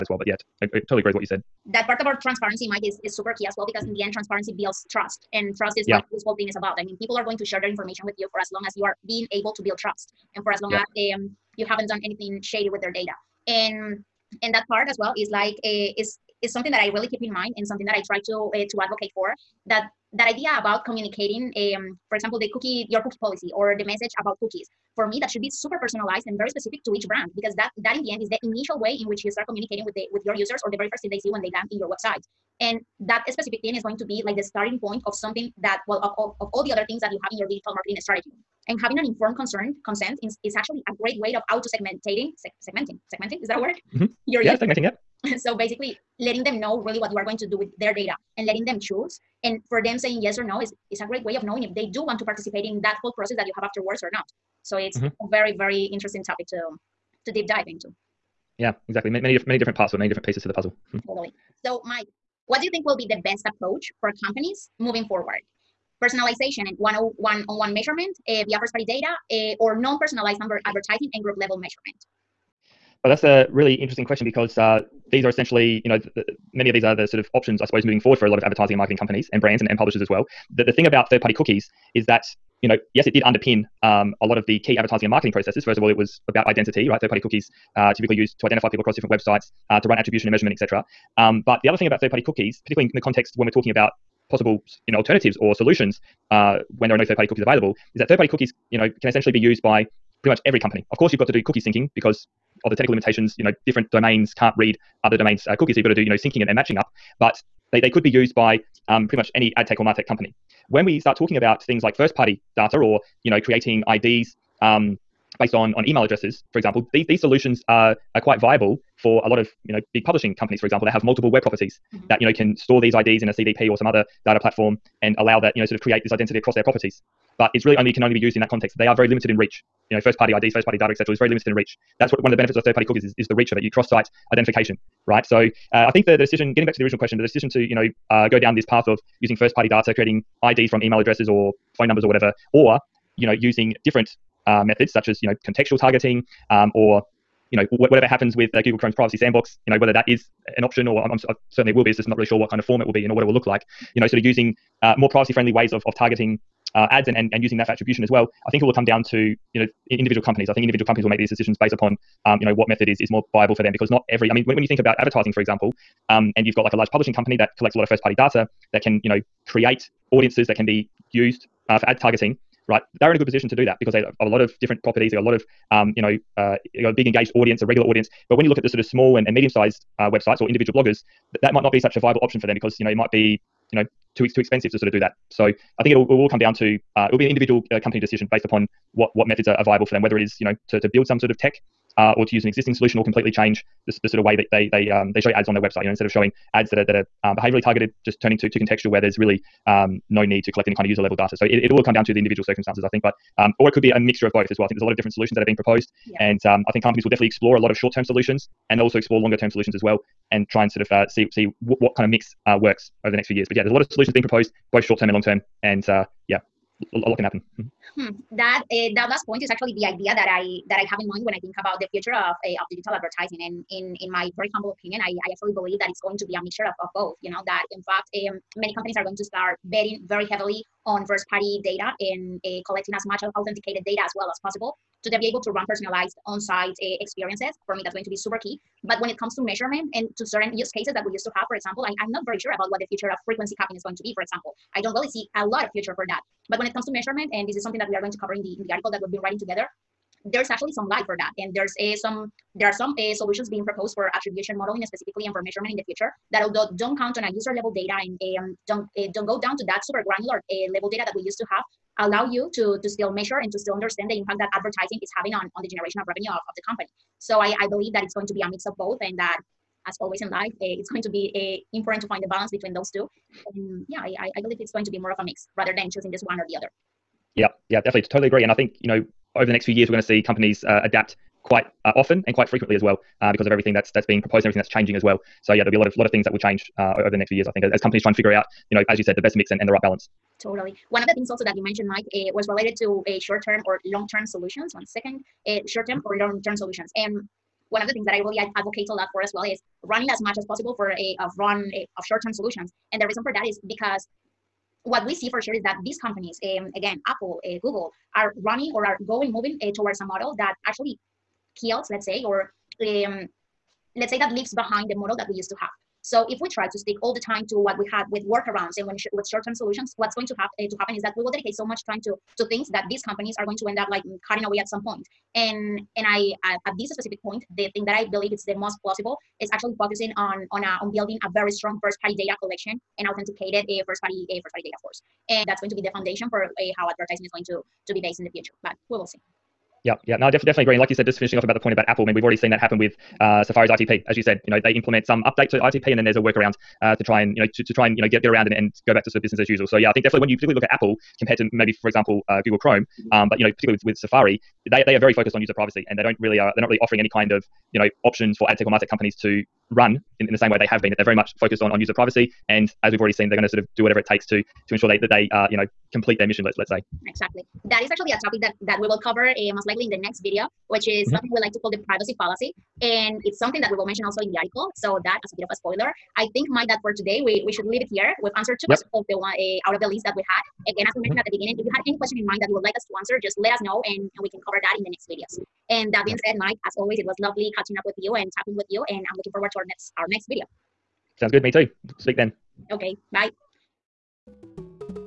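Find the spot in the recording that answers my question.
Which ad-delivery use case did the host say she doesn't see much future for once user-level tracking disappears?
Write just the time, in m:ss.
4:03.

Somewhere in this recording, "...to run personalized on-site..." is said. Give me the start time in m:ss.
3:55.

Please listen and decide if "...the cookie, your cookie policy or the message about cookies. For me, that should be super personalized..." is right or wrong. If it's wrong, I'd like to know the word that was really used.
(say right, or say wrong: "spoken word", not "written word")
right.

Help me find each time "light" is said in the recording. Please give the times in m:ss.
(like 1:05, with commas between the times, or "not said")
4:10.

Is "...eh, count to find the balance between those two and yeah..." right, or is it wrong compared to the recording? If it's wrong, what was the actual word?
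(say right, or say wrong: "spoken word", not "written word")
wrong: "important", not "count".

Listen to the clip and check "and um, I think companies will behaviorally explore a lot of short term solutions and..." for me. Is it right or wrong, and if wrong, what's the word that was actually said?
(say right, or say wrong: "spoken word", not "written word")
wrong: "definitely", not "behaviorally".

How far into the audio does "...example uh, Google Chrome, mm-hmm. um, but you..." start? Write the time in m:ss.
5:51.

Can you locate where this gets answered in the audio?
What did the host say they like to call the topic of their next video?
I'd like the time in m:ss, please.
6:11.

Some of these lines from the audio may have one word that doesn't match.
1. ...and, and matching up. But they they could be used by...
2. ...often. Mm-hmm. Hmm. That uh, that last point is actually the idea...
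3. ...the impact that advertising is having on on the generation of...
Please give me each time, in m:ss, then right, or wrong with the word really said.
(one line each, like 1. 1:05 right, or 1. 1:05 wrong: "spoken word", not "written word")
1. 1:46 right
2. 3:37 wrong: "happen", not "often"
3. 4:24 right.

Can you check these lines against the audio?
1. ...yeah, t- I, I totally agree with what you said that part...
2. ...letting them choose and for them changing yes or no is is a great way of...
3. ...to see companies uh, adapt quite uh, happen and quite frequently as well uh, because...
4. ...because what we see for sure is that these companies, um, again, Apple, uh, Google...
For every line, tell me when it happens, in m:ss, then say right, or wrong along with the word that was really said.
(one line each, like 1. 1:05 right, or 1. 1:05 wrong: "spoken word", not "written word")
1. 0:00 right
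2. 0:48 wrong: "saying", not "changing"
3. 4:39 wrong: "often", not "happen"
4. 5:03 right.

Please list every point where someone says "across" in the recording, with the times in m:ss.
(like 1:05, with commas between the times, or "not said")
1:28, 2:06.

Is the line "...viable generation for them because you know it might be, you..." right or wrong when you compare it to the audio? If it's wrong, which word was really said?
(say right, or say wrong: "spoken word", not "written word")
wrong: "option", not "generation".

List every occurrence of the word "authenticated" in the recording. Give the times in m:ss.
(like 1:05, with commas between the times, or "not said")
3:53, 5:33.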